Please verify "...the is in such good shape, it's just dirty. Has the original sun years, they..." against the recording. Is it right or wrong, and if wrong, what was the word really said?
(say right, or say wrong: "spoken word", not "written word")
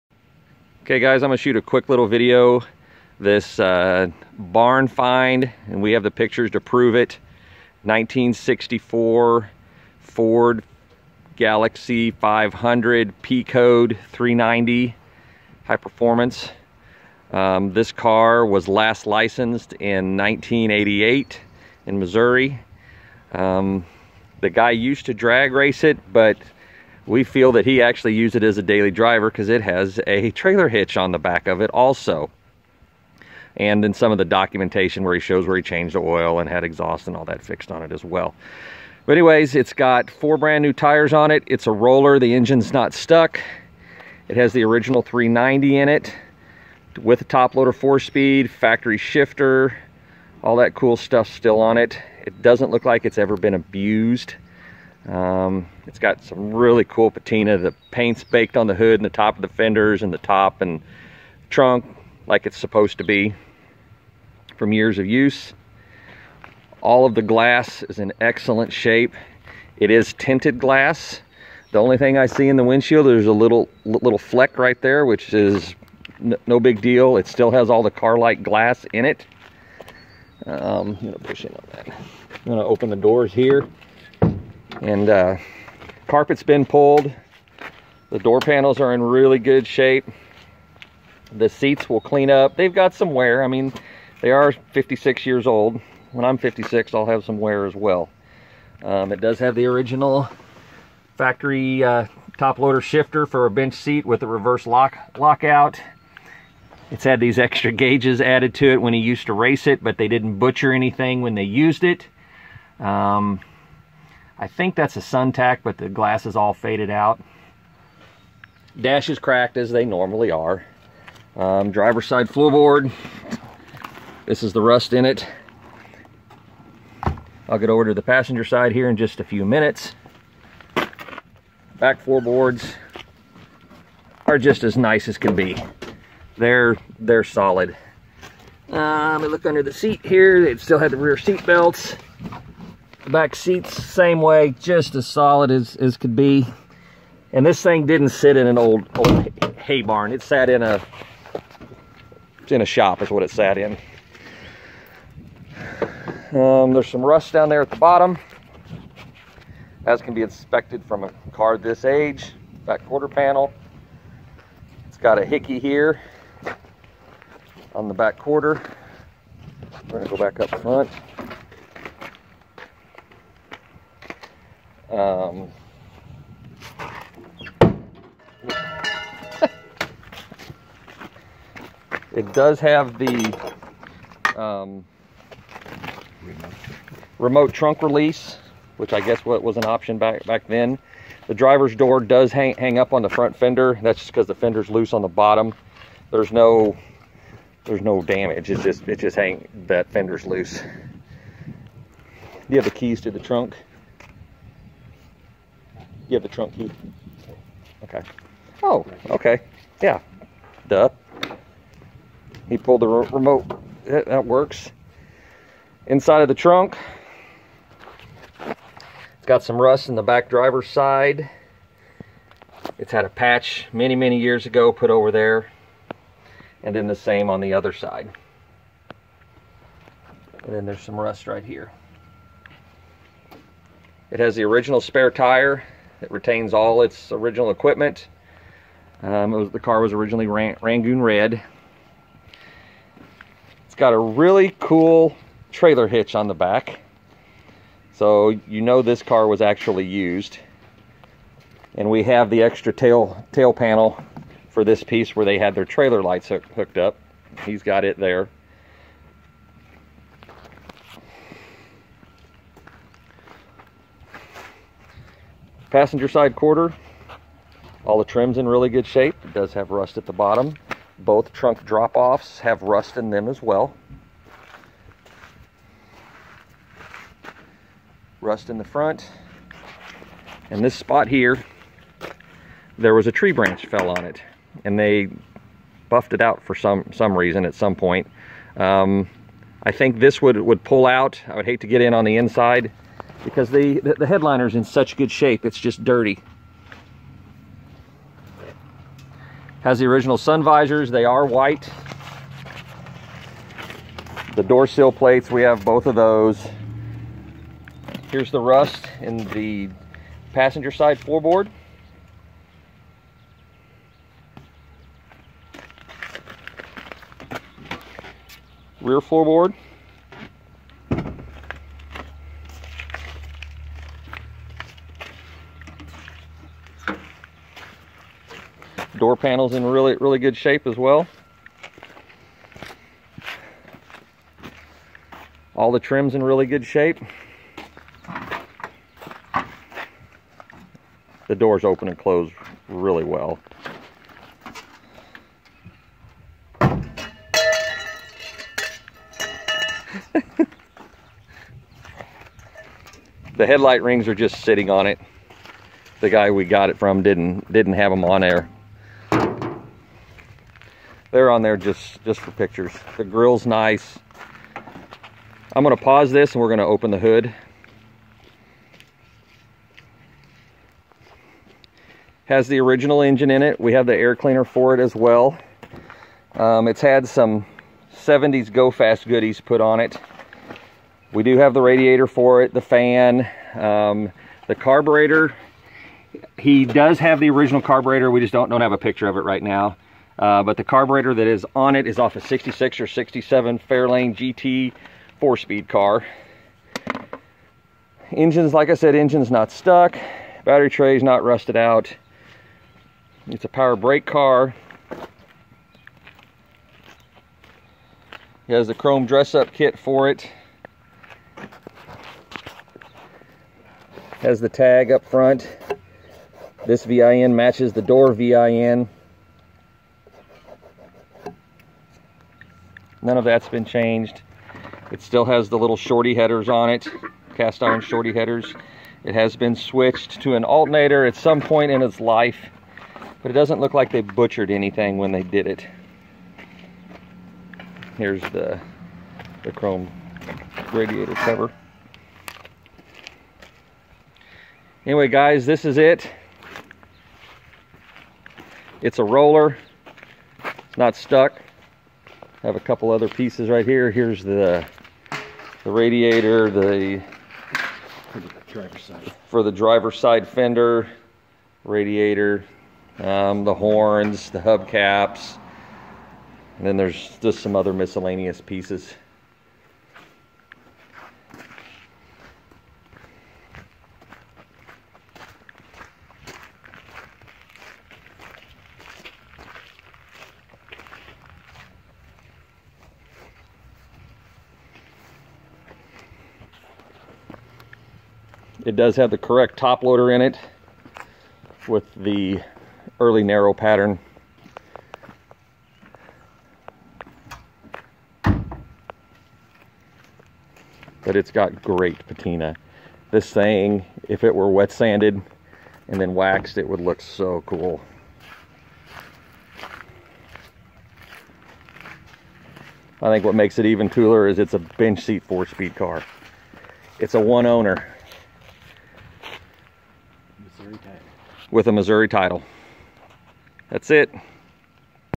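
wrong: "visors", not "years".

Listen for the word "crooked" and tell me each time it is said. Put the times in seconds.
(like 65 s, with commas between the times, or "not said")
not said.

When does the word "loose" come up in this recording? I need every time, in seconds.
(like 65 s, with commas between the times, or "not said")
194 s, 200 s.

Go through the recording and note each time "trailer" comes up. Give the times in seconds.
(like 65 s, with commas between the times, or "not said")
30 s, 245 s, 255 s.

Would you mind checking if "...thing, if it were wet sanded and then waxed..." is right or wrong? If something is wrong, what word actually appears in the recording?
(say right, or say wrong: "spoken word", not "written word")
right.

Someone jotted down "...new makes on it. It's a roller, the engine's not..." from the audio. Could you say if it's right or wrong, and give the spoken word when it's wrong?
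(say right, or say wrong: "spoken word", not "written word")
wrong: "tires", not "makes".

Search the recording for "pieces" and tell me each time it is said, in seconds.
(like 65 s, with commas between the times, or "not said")
254 s, 453 s, 468 s.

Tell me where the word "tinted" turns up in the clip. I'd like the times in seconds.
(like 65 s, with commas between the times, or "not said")
70 s.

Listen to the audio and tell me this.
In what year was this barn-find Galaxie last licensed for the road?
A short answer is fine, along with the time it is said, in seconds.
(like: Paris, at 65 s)
1988, at 20 s.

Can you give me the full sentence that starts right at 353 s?
the headlight rings are just sitting on it.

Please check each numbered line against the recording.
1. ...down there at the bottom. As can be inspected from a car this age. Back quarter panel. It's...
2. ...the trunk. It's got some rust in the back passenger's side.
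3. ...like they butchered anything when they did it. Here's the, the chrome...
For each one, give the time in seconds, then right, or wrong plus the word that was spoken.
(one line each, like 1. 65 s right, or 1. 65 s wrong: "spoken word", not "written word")
1. 157 s right
2. 216 s wrong: "driver", not "passenger"
3. 433 s right.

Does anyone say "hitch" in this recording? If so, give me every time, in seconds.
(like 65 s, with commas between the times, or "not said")
30 s, 245 s.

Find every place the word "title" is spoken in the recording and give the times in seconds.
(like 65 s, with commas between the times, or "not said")
522 s.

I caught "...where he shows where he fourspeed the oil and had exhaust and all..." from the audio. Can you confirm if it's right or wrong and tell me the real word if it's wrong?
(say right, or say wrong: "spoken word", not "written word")
wrong: "changed", not "fourspeed".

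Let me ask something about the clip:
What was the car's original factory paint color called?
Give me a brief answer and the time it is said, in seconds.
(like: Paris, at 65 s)
Rangoon Red, at 240 s.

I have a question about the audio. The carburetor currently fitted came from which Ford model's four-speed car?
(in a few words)
Fairlane GT.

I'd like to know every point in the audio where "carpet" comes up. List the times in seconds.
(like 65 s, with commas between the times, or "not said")
86 s.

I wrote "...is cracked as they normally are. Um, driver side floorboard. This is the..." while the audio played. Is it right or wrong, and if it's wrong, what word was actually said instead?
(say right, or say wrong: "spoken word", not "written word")
right.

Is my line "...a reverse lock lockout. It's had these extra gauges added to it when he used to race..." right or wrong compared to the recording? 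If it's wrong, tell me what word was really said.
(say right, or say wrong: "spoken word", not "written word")
right.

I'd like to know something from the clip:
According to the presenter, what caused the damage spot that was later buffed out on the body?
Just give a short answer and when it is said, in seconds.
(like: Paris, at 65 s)
A tree branch, at 283 s.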